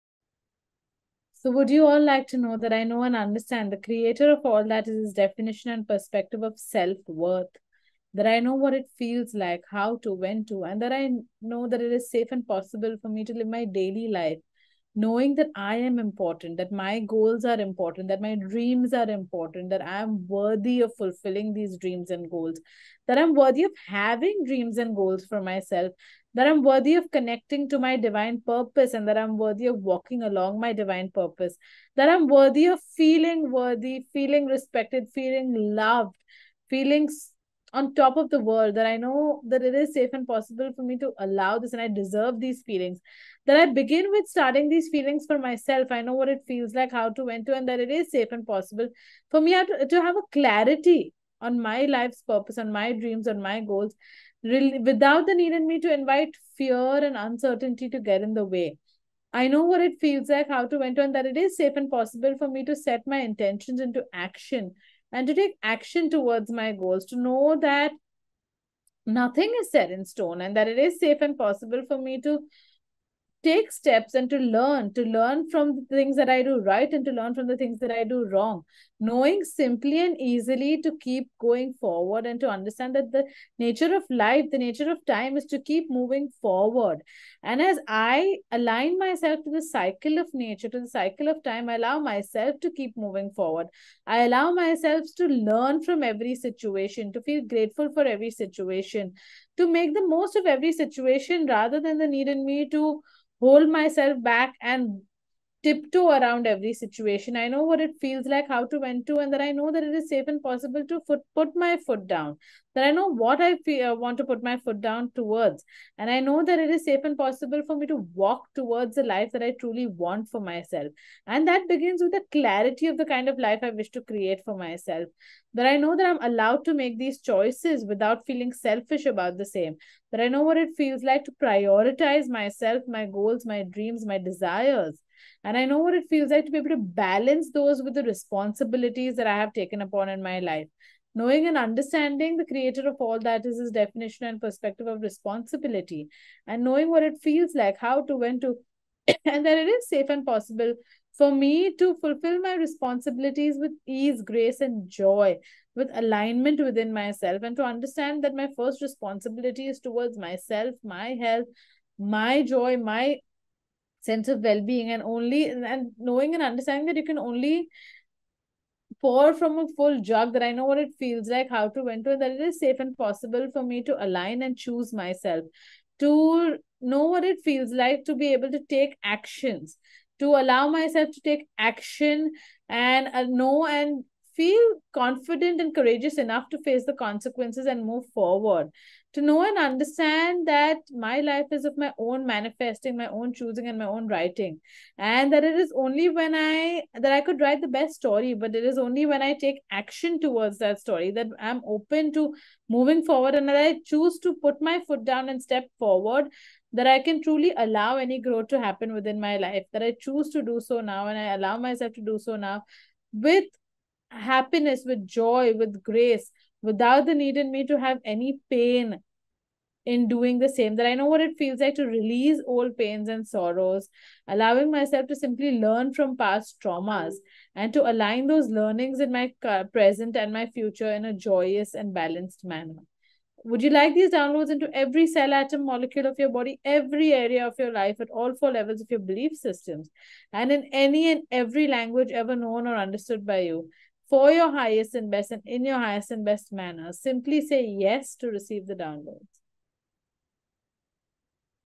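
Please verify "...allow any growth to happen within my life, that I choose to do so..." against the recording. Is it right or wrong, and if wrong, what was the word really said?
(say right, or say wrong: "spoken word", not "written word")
right.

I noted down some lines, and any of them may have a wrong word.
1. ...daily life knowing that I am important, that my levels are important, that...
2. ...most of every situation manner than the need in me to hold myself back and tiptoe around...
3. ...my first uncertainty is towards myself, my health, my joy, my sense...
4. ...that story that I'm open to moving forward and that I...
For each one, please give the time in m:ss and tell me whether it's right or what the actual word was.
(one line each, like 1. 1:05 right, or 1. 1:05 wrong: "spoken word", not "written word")
1. 0:13 wrong: "goals", not "levels"
2. 1:40 wrong: "rather", not "manner"
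3. 2:38 wrong: "responsibility", not "uncertainty"
4. 3:20 right.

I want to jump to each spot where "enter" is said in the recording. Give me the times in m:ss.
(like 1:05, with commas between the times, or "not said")
0:47, 1:00, 2:51.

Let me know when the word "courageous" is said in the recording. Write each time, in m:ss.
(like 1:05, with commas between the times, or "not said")
3:05.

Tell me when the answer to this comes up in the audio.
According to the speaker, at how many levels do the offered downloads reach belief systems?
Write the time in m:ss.
3:58.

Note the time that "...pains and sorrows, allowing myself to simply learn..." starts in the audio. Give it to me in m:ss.
3:42.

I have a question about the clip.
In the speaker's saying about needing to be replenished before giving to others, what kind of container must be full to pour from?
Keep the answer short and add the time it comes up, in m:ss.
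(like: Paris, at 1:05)
full jug, at 2:49.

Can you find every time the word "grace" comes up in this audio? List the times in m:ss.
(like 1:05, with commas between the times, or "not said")
2:34, 3:35.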